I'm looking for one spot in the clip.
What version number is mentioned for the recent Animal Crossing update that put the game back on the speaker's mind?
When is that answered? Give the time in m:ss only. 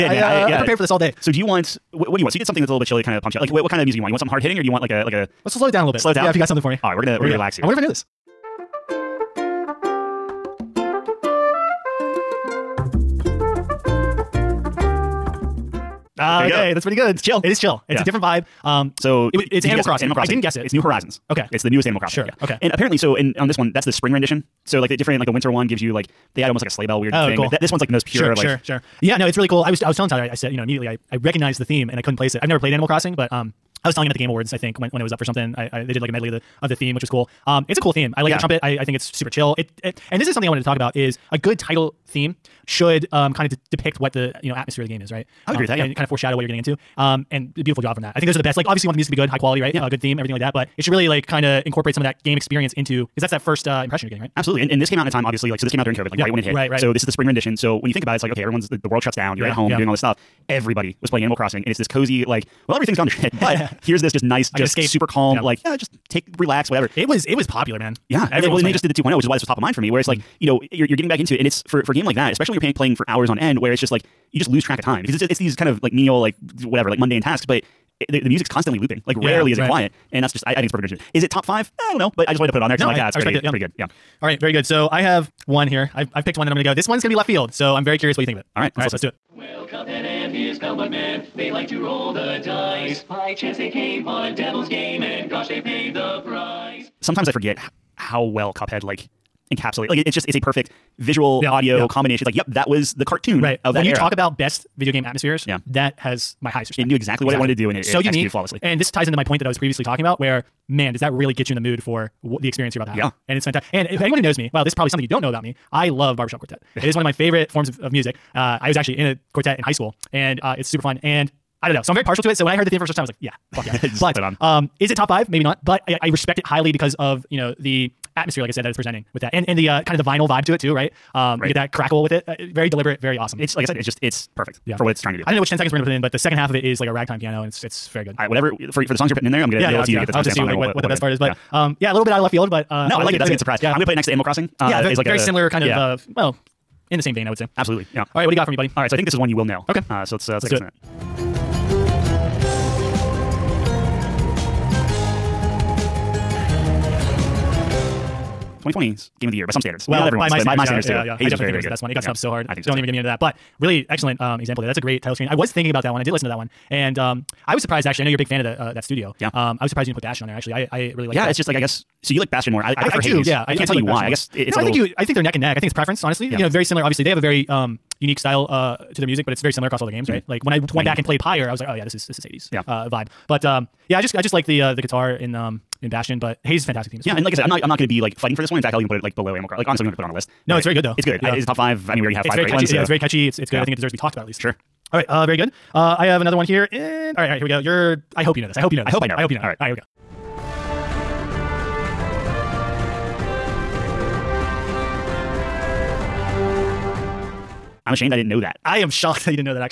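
1:08.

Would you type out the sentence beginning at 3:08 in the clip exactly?
In fact, I'll even put it like below Animal Crossing.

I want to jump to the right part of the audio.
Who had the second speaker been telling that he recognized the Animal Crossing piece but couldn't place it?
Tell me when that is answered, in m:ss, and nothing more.
0:30.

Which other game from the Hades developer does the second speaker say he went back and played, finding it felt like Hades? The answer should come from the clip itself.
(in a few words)
Pyre.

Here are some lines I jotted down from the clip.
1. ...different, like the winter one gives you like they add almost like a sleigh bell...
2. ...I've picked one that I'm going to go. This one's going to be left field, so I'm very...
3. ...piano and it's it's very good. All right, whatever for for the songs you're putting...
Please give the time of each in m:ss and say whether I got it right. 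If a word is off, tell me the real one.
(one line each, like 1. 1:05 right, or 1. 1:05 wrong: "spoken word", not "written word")
1. 0:24 right
2. 1:26 right
3. 2:17 right.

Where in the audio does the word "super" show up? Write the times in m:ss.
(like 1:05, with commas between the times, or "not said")
0:39, 1:04, 2:00.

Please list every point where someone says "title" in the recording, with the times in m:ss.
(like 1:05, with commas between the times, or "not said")
0:41, 2:45.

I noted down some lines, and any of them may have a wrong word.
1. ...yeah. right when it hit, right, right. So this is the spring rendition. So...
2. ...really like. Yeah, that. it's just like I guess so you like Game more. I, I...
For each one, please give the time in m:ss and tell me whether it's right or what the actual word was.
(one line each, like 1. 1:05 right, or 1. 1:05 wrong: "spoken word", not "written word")
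1. 0:56 right
2. 2:50 wrong: "Bastion", not "Game".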